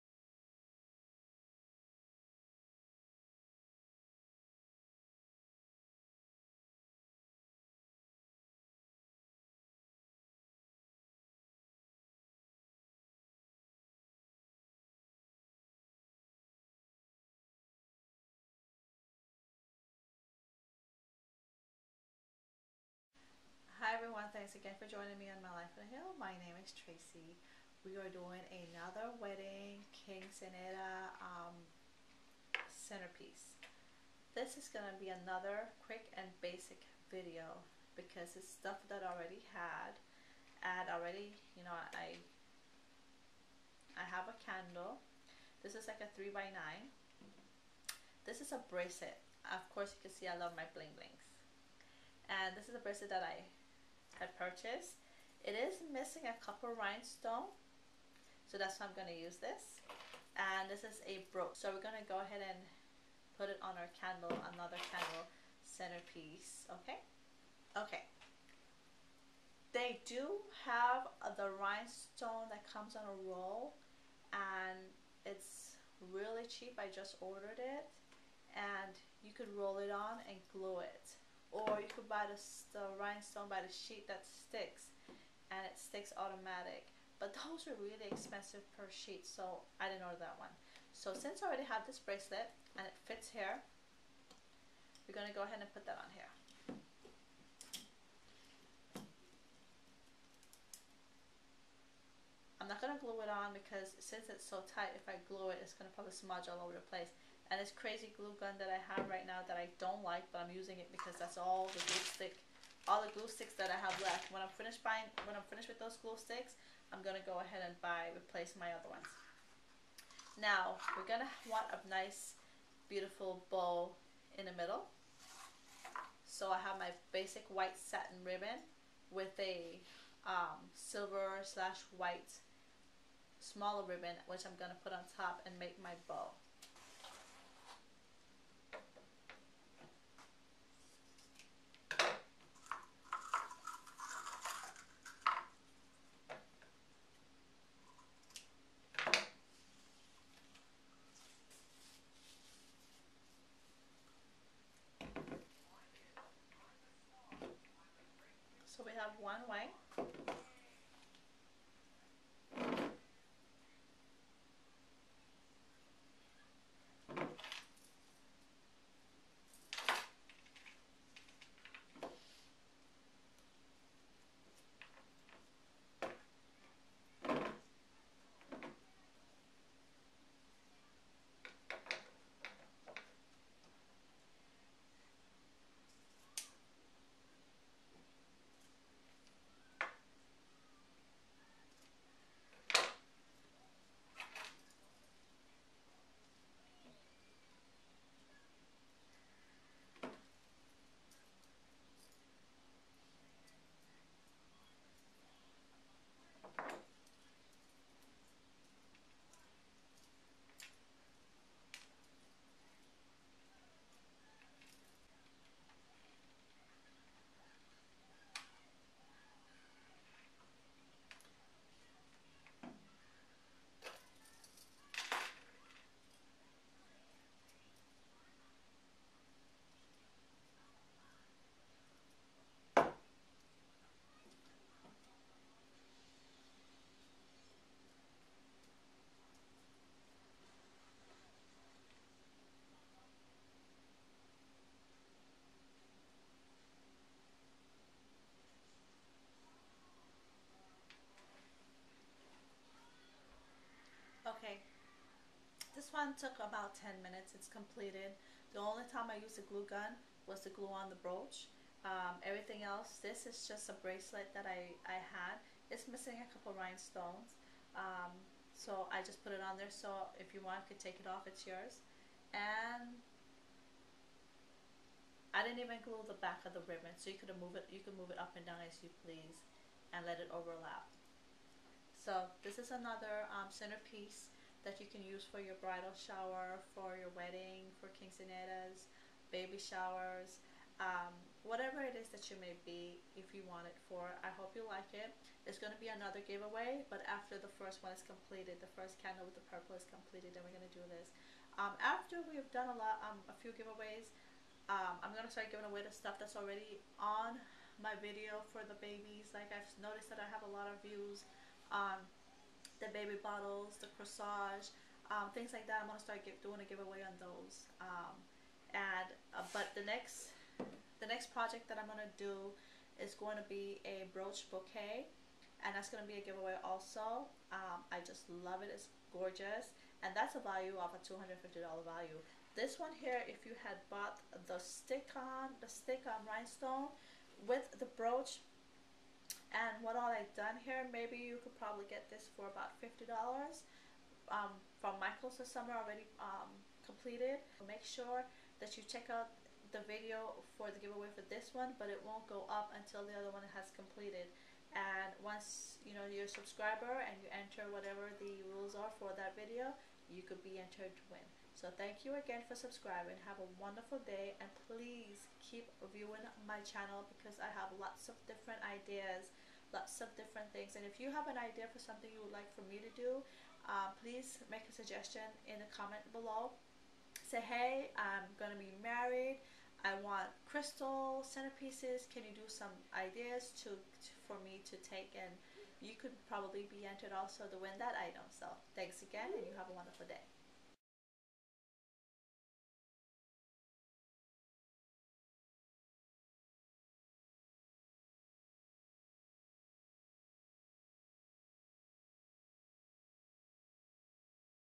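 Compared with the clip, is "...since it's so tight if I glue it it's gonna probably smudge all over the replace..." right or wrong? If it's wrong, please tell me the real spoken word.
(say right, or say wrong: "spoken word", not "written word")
wrong: "place", not "replace".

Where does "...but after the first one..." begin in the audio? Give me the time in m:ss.
4:56.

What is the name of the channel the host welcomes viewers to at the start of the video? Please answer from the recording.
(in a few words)
My Life on a Hill.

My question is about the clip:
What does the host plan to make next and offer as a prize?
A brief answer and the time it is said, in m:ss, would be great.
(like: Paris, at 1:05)
brooch bouquet, at 5:24.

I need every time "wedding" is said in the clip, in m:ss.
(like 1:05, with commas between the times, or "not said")
0:29, 4:47.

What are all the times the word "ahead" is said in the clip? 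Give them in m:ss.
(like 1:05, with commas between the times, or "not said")
1:02, 1:35, 1:57.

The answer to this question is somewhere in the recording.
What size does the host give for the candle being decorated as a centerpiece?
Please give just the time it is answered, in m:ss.
0:46.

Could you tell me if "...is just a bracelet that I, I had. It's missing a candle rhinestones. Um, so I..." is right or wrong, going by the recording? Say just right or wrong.
wrong.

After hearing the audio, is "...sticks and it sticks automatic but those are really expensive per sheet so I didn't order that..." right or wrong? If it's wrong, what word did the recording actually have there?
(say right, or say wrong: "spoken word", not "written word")
right.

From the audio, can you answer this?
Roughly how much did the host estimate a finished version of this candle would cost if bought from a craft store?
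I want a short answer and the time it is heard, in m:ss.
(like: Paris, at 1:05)
$50, at 5:42.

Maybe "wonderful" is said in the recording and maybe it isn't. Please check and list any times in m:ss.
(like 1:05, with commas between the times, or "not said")
6:03, 6:29.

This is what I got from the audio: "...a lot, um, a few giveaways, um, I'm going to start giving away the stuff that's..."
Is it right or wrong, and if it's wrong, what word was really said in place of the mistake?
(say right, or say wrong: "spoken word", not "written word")
right.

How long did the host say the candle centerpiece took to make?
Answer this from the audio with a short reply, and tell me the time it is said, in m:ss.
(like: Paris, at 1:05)
10 minutes, at 4:16.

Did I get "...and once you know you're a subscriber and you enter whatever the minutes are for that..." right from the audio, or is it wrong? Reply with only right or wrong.
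wrong.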